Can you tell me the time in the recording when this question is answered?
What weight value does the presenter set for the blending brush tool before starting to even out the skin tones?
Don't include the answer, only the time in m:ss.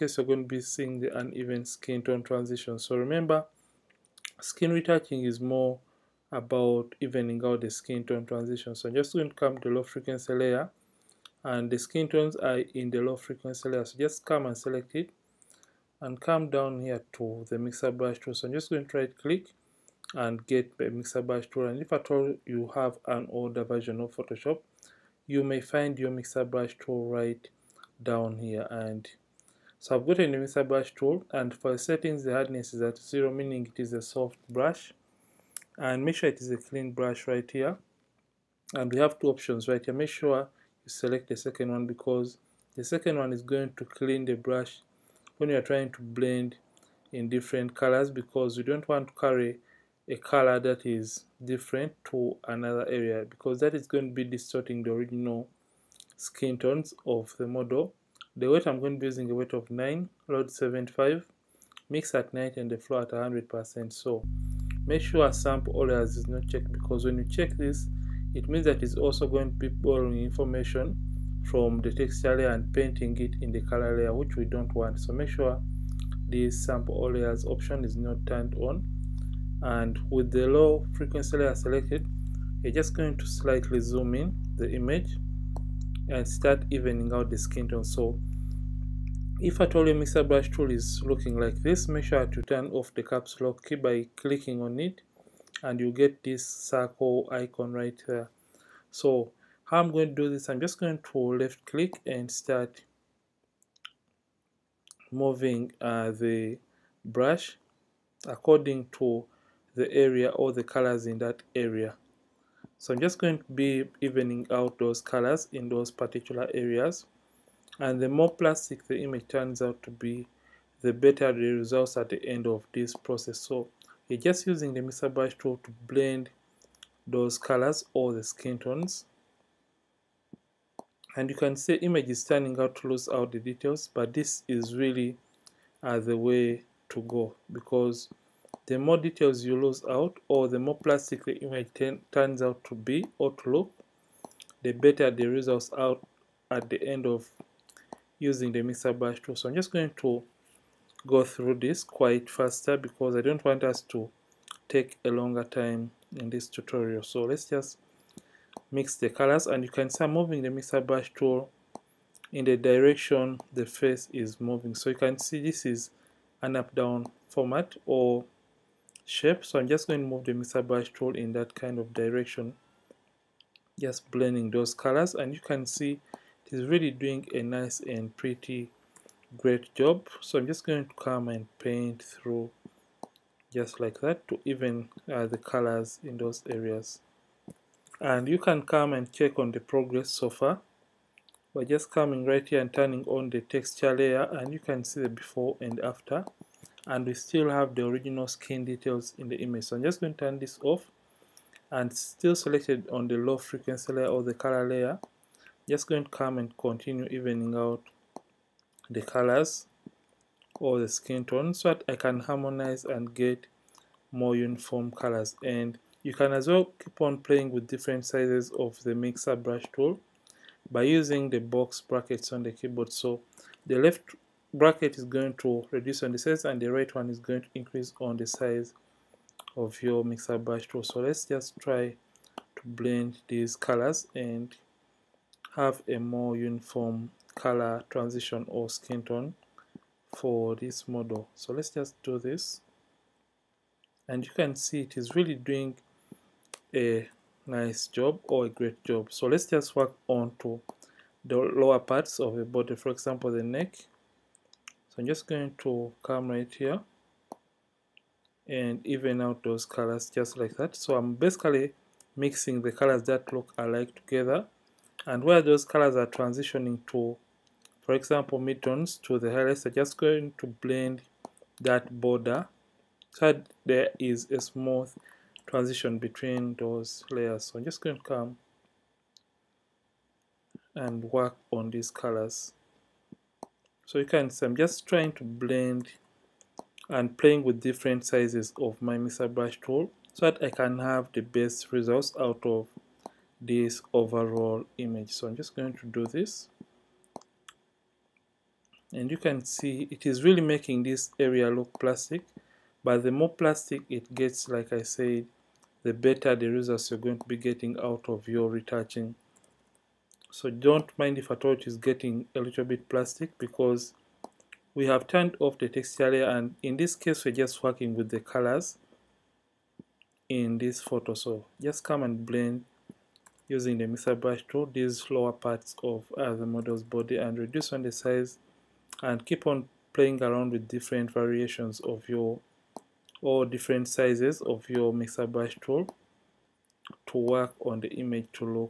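0:59.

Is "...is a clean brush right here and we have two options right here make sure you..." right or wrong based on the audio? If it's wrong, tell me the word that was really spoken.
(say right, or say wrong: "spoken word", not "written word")
right.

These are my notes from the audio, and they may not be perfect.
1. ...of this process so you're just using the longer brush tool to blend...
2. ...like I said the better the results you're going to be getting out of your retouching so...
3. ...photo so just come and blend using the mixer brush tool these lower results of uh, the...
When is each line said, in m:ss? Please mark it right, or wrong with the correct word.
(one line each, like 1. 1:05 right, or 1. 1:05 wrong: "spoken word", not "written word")
1. 2:02 wrong: "mixer", not "longer"
2. 5:04 right
3. 5:20 wrong: "parts", not "results".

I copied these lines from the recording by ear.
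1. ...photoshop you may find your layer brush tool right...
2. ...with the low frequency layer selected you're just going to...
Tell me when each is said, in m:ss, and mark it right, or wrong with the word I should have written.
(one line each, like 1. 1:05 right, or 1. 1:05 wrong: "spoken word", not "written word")
1. 0:24 wrong: "mixer", not "layer"
2. 1:20 right.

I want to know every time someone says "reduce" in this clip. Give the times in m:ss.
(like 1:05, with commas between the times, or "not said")
3:45, 5:27.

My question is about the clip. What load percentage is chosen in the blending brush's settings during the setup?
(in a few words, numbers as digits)
75.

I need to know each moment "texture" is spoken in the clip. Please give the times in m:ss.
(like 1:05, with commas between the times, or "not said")
1:11, 3:13, 5:15.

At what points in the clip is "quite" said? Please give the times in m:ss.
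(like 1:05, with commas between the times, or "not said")
2:31.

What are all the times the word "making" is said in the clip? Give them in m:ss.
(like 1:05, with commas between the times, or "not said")
5:00.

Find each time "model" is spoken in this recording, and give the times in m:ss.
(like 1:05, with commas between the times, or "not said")
0:57, 4:00, 5:26.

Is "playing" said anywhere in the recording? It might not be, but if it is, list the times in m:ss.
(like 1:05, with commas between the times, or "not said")
3:37, 4:47, 5:29.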